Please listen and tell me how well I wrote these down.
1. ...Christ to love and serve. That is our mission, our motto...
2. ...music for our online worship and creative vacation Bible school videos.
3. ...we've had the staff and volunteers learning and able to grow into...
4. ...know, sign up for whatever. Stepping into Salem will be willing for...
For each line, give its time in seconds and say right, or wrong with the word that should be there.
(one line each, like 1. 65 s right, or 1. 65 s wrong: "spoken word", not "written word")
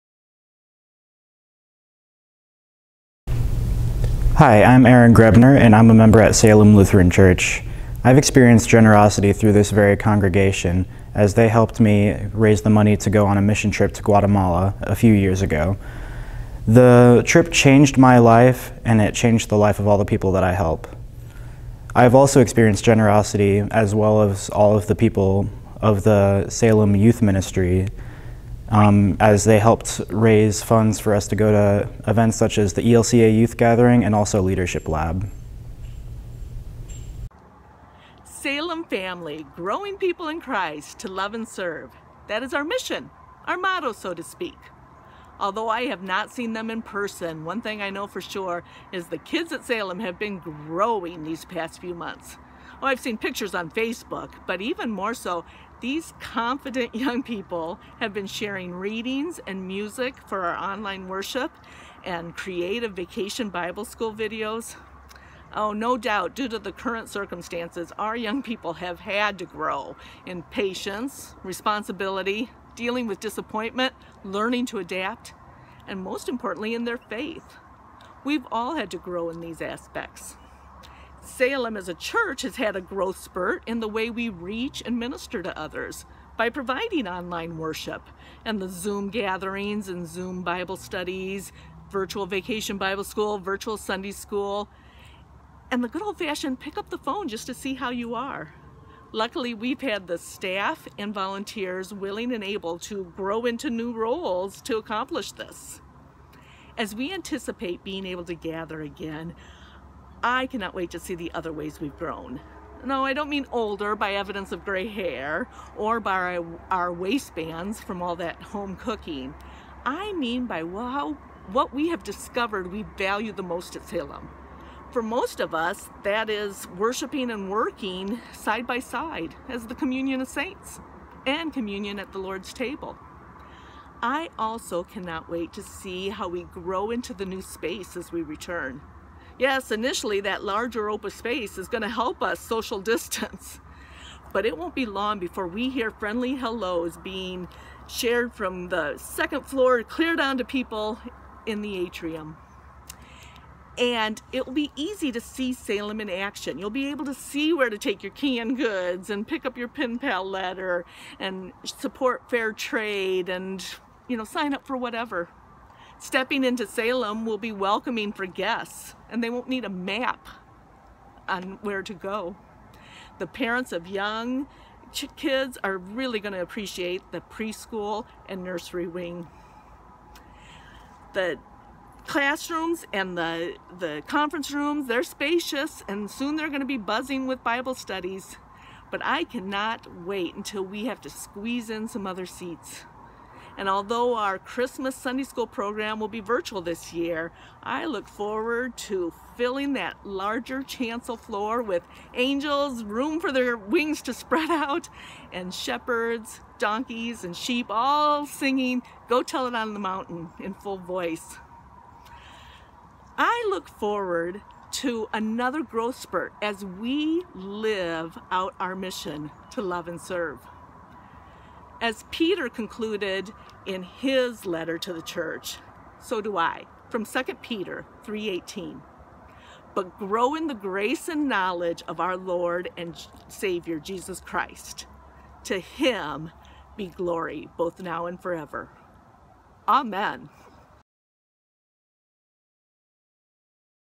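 1. 40 s right
2. 59 s right
3. 99 s wrong: "willing", not "learning"
4. 164 s wrong: "welcoming", not "willing".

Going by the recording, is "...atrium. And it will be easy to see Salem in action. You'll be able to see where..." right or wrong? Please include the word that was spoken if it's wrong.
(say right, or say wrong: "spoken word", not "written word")
right.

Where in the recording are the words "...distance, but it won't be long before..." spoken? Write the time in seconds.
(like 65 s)
142 s.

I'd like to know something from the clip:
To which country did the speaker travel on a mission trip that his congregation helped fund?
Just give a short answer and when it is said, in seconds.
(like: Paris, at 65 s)
Guatemala, at 14 s.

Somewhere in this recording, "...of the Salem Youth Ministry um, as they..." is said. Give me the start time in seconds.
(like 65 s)
25 s.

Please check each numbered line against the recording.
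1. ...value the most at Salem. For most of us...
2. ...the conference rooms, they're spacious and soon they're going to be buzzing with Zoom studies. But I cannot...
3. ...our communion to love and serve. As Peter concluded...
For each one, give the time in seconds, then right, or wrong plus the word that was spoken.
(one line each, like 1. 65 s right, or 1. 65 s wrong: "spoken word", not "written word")
1. 122 s right
2. 183 s wrong: "Bible", not "Zoom"
3. 218 s wrong: "mission", not "communion".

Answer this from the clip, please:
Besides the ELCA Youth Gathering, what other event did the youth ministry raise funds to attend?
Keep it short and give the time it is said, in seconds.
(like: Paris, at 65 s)
Leadership Lab, at 34 s.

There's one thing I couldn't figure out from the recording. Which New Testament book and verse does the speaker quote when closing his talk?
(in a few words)
2 Peter 3:18.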